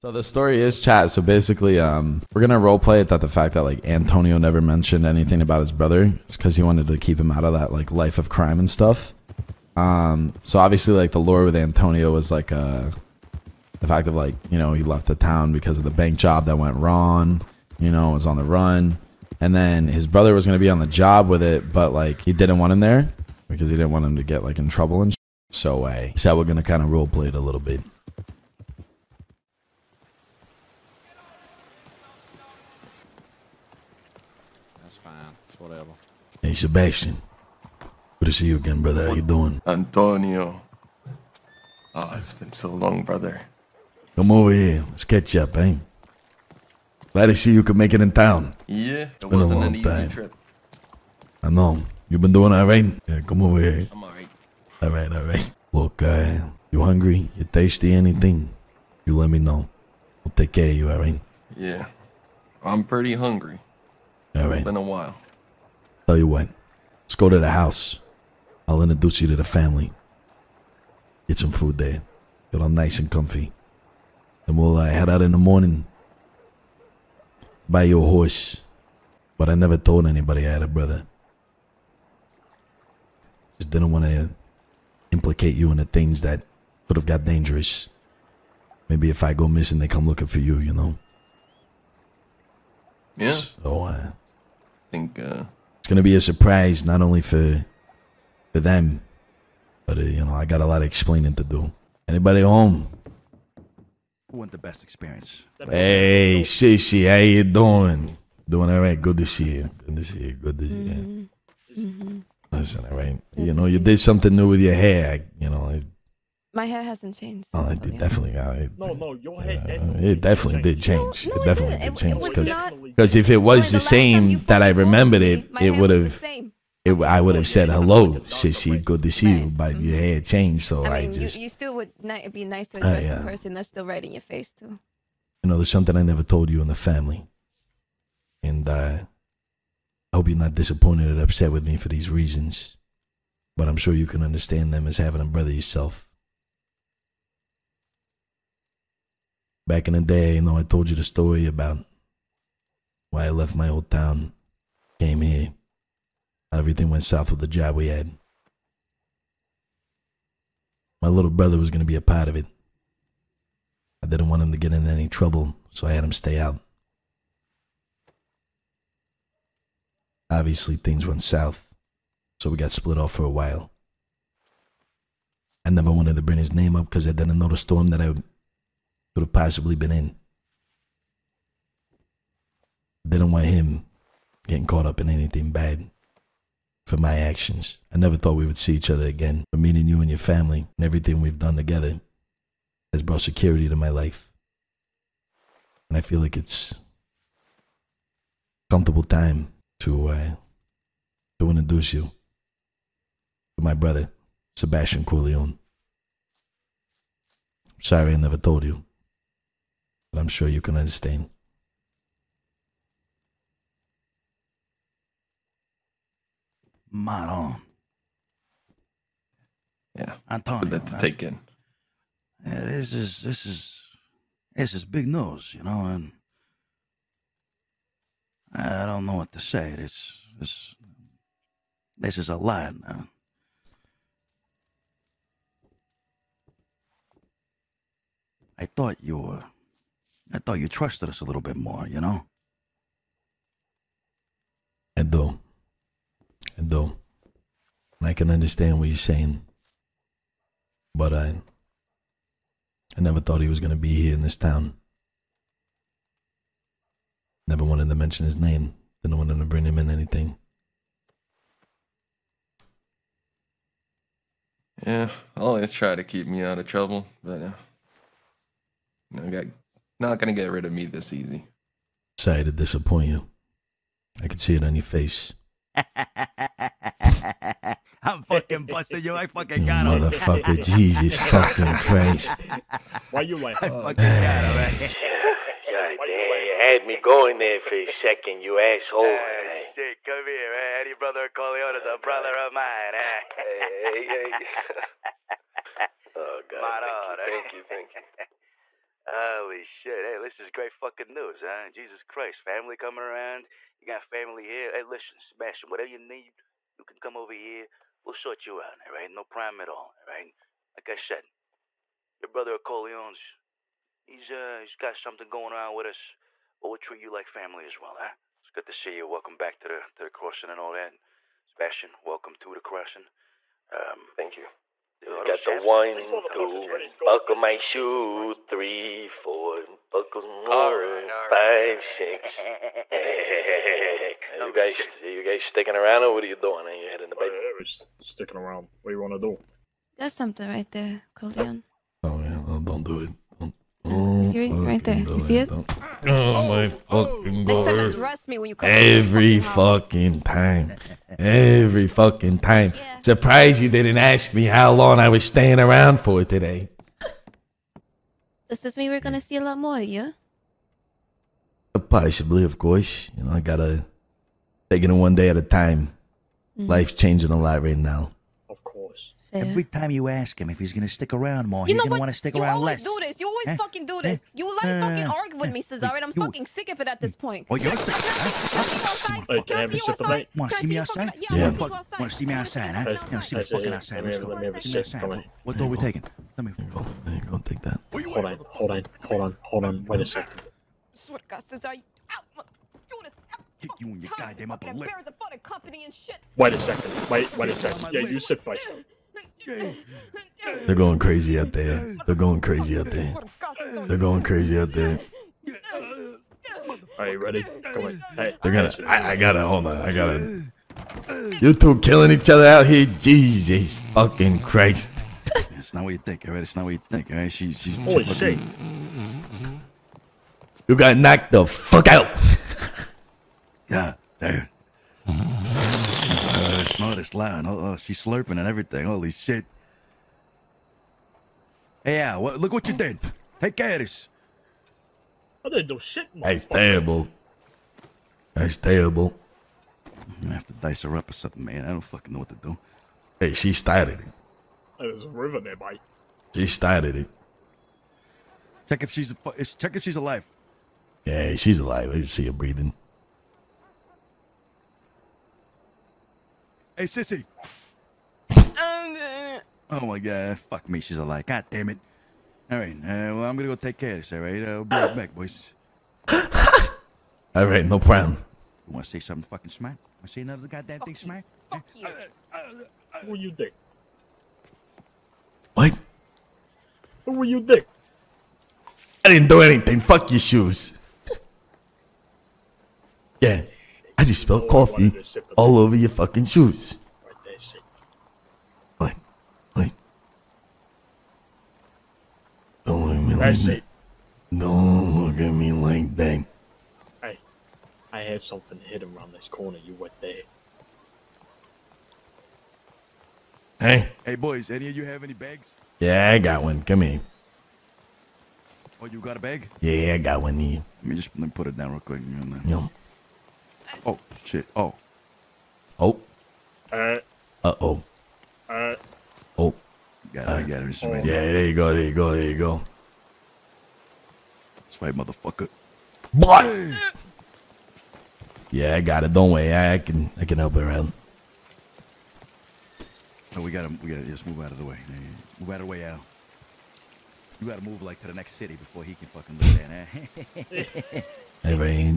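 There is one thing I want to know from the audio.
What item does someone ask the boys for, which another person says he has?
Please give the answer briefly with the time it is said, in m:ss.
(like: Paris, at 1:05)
a bag, at 8:25.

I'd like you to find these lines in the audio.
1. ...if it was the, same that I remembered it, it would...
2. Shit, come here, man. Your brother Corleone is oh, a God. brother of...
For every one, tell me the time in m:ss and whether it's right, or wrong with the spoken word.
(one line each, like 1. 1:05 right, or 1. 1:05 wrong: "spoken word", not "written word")
1. 2:03 right
2. 4:49 right.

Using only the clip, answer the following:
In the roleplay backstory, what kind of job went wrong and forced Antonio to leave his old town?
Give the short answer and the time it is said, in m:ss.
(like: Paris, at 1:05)
bank job, at 0:15.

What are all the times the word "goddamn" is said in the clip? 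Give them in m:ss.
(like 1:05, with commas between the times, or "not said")
6:34, 7:50.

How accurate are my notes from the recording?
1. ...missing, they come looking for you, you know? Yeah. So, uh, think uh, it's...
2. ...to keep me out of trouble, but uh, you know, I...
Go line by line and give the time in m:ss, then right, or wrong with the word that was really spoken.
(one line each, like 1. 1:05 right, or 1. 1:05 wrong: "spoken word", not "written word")
1. 1:29 right
2. 4:25 right.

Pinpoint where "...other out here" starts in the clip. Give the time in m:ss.
6:52.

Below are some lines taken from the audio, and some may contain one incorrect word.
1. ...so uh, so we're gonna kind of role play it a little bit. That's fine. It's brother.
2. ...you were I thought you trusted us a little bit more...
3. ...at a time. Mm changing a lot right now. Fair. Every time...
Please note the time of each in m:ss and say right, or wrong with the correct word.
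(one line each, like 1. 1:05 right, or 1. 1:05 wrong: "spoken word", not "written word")
1. 0:25 wrong: "whatever", not "brother"
2. 3:59 right
3. 6:05 right.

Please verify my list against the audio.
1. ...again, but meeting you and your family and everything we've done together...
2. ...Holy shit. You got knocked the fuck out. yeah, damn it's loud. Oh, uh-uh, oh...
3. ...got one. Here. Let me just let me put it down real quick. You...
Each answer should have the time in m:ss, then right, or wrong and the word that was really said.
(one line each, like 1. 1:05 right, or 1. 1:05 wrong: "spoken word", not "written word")
1. 3:09 right
2. 6:57 right
3. 8:29 right.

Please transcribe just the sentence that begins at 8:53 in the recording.
So we gotta we gotta just move out of the way.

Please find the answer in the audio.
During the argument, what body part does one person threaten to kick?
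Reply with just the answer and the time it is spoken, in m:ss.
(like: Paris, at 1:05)
upper lip, at 6:34.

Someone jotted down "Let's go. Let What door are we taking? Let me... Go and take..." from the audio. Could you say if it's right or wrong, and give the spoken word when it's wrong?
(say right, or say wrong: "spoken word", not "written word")
right.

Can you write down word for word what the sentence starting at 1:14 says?
And we'll uh, head out in the morning.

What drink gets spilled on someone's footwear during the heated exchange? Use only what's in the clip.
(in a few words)
coffee.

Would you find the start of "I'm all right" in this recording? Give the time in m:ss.
0:53.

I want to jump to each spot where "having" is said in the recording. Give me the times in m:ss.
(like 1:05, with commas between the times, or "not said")
2:24.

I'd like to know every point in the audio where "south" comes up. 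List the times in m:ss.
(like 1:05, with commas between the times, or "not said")
2:37, 2:51.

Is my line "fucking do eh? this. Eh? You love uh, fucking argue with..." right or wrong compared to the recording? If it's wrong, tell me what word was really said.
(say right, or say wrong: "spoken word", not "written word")
right.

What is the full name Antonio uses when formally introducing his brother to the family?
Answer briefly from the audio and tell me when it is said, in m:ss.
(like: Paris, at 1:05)
Sebastian Corleone, at 3:24.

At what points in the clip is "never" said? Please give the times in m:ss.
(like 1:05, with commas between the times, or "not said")
0:04, 1:19, 2:16, 2:55, 3:07, 3:28, 4:13, 4:17.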